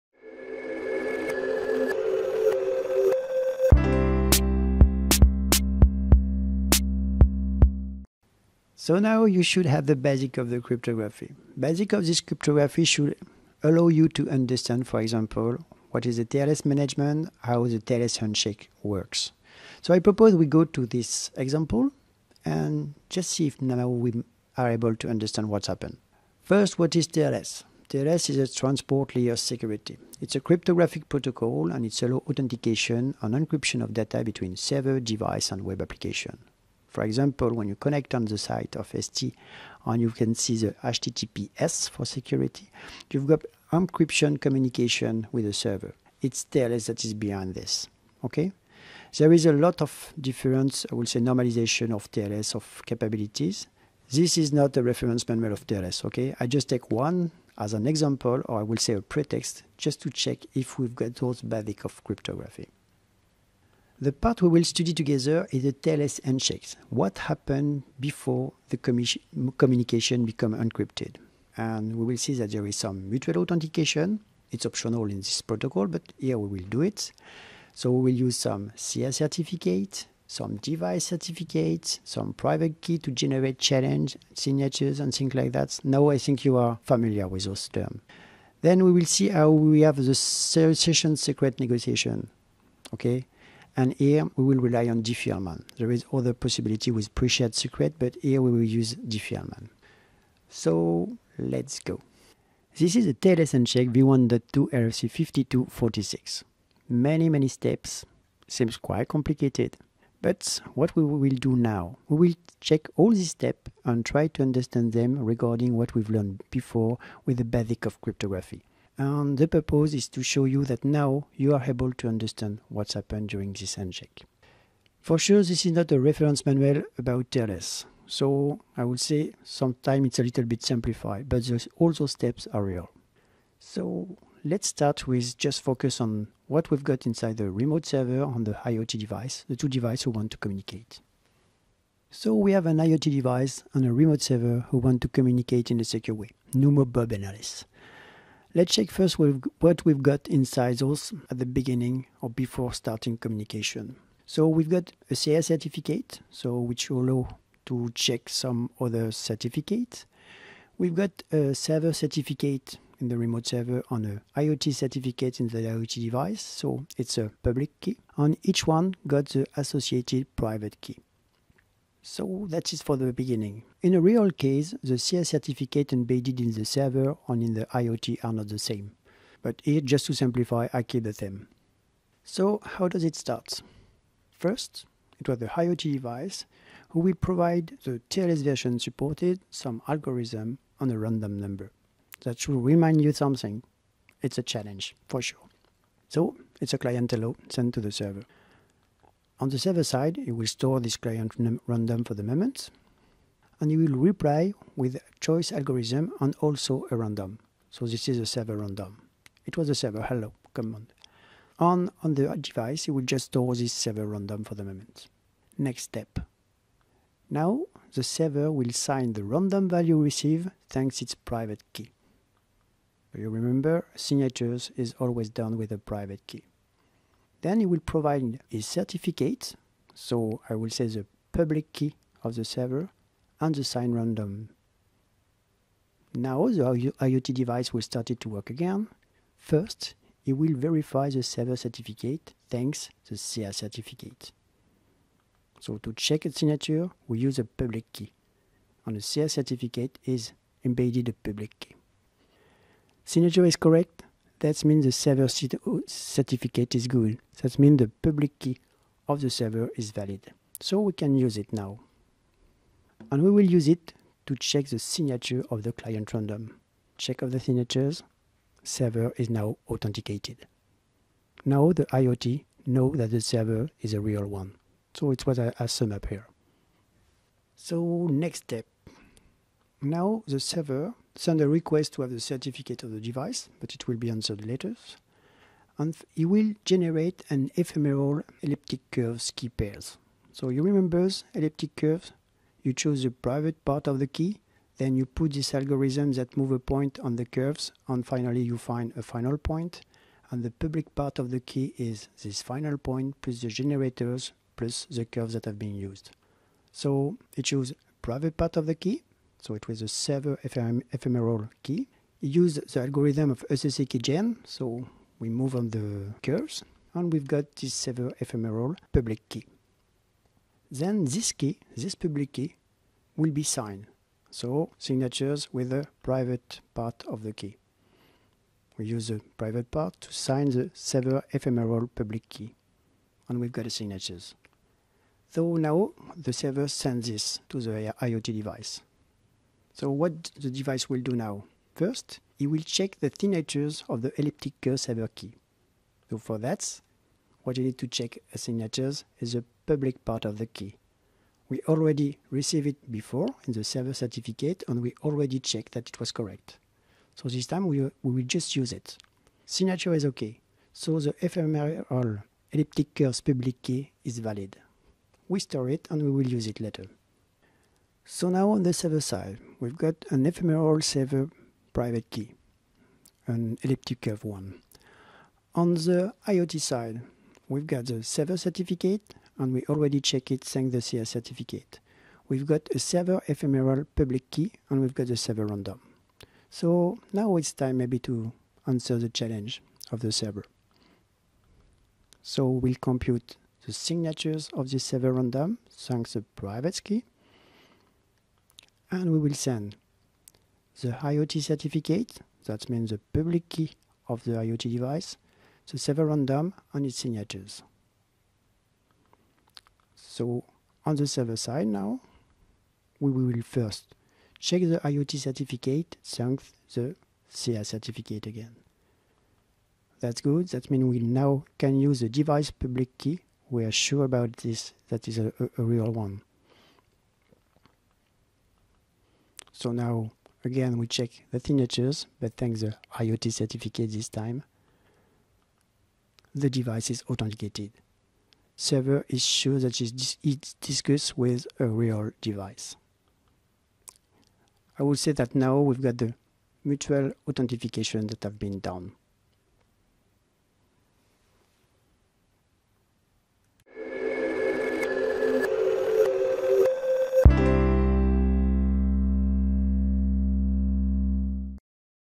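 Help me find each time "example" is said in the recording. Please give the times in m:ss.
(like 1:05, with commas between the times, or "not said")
0:14, 0:21, 0:37, 0:57.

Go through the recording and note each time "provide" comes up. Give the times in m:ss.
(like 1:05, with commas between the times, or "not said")
3:07, 3:47.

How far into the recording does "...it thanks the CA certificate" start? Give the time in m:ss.
6:20.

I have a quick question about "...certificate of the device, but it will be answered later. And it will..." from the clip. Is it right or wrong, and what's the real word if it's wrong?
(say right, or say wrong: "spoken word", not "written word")
right.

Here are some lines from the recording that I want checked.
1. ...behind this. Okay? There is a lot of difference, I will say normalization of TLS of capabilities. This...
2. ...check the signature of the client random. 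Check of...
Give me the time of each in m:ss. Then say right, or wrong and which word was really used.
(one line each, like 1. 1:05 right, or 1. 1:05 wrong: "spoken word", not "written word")
1. 0:47 right
2. 4:24 right.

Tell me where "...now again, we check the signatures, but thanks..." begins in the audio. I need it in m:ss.
7:09.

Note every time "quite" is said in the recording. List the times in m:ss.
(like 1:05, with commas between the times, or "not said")
1:48.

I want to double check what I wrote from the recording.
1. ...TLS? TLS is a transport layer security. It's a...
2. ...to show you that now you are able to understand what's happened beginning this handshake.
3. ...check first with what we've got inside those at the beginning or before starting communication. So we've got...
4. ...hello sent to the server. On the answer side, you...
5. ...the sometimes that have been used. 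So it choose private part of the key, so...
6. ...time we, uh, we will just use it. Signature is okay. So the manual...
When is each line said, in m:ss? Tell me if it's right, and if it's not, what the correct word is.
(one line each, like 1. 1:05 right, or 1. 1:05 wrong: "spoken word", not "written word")
1. 0:27 right
2. 2:00 wrong: "during", not "beginning"
3. 2:28 right
4. 3:17 wrong: "server", not "answer"
5. 5:04 wrong: "curves", not "sometimes"
6. 5:57 wrong: "ephemeral", not "manual".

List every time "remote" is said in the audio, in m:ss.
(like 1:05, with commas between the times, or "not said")
2:17, 2:23, 2:43.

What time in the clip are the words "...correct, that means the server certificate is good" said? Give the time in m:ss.
4:13.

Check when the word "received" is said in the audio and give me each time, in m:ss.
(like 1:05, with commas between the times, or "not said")
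3:39, 5:52.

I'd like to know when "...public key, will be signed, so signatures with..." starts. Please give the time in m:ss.
5:21.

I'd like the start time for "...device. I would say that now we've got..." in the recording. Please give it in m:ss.
7:22.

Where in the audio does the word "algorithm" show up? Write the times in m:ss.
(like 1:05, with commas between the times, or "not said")
3:09, 3:25, 4:55, 5:12.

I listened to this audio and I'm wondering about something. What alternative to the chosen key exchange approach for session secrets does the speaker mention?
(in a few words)
Pre-shared secret.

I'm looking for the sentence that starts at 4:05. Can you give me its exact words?
So to check its signature, we use a public key.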